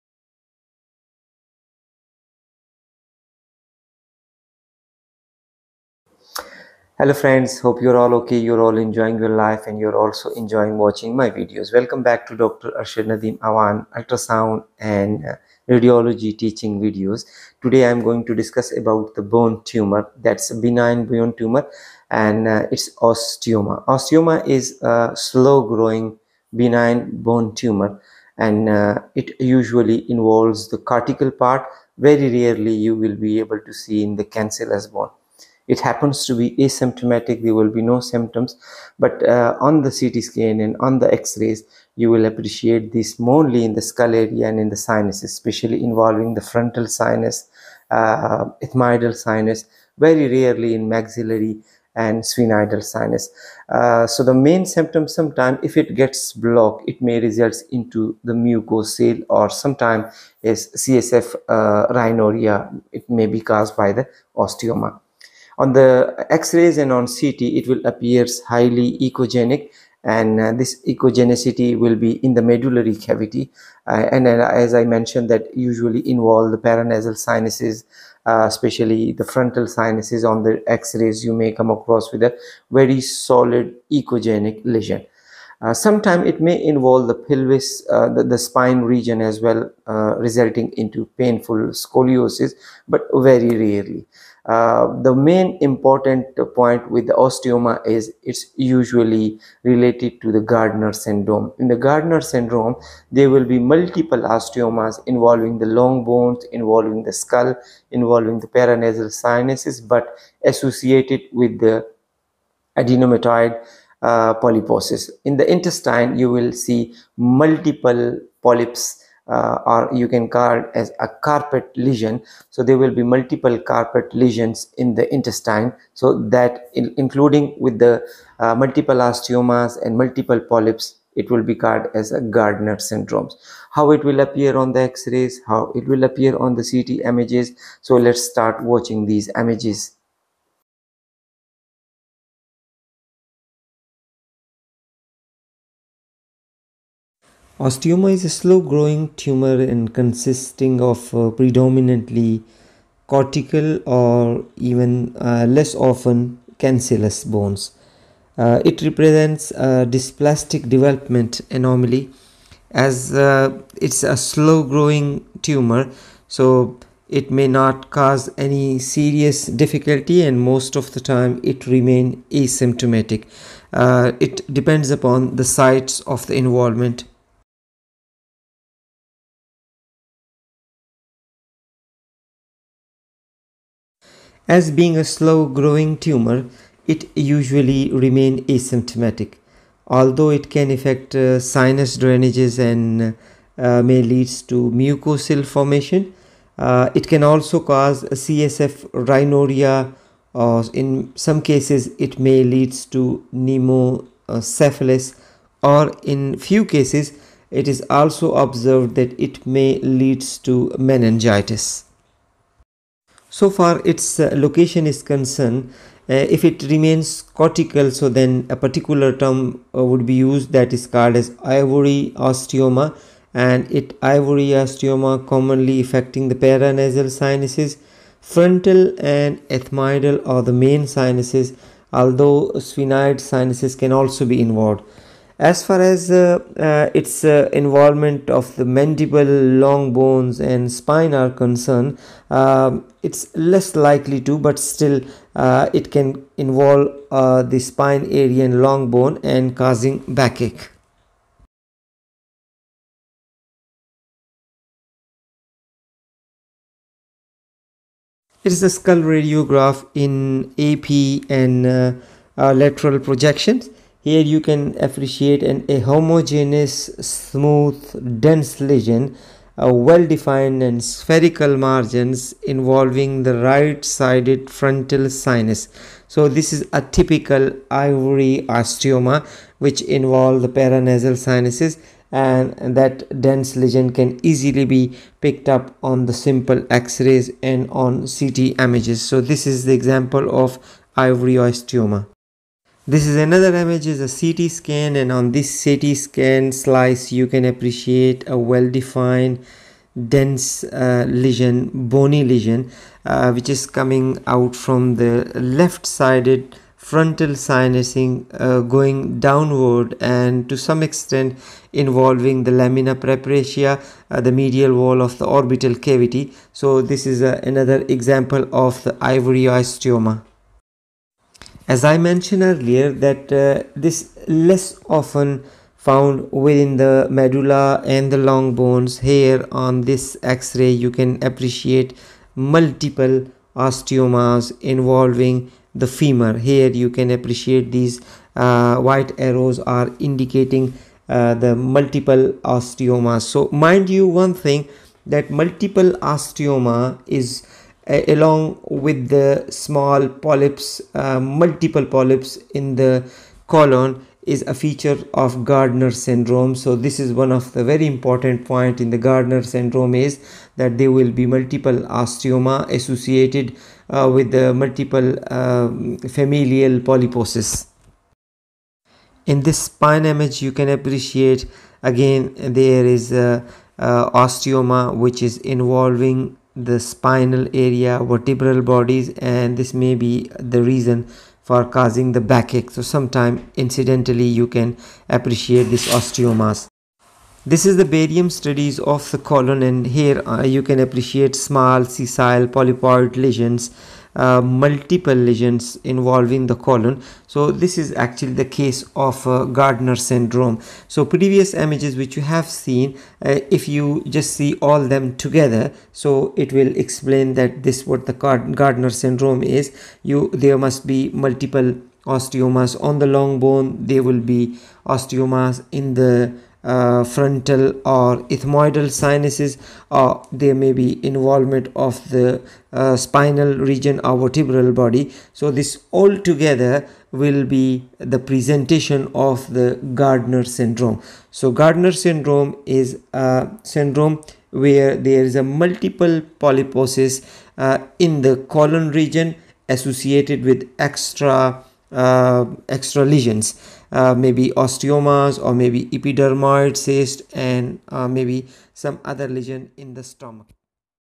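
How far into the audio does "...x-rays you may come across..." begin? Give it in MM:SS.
01:20.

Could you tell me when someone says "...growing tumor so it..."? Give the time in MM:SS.
02:44.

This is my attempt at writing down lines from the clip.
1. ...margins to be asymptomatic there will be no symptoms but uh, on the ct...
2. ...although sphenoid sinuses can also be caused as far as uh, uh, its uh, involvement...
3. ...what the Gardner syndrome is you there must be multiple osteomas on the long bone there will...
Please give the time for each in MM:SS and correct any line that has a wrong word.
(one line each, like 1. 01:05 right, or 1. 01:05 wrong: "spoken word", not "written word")
1. 00:35 wrong: "happens", not "margins"
2. 03:51 wrong: "involved", not "caused"
3. 06:47 right.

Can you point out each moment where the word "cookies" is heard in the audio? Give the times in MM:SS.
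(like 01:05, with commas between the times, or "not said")
not said.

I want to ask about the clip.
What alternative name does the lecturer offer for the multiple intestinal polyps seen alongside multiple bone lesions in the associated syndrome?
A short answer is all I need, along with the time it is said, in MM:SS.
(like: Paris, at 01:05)
carpet lesion, at 02:01.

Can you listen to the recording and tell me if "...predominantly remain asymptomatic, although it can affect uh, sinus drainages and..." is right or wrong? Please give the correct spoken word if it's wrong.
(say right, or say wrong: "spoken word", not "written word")
wrong: "usually", not "predominantly".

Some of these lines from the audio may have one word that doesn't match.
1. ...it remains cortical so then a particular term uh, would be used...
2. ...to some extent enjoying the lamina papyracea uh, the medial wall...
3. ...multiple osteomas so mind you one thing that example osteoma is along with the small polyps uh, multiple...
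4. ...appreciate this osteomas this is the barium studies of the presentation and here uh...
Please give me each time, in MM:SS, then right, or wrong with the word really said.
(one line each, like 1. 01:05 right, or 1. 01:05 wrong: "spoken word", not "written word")
1. 03:36 right
2. 05:10 wrong: "involving", not "enjoying"
3. 05:41 wrong: "multiple", not "example"
4. 06:25 wrong: "colon", not "presentation".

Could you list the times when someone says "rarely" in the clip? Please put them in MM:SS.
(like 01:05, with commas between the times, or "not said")
00:32, 00:50, 01:33.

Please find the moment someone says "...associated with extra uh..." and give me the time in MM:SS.
07:19.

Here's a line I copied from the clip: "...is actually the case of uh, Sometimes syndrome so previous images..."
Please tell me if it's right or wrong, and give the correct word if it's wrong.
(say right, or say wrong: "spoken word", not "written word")
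wrong: "Gardner", not "Sometimes".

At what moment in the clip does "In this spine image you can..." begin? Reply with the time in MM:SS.
06:09.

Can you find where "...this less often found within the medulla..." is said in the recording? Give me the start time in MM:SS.
05:23.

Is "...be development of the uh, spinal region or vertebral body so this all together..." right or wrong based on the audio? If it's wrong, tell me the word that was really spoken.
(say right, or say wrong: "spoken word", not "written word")
wrong: "involvement", not "development".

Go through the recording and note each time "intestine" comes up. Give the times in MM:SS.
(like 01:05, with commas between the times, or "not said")
01:55, 02:05.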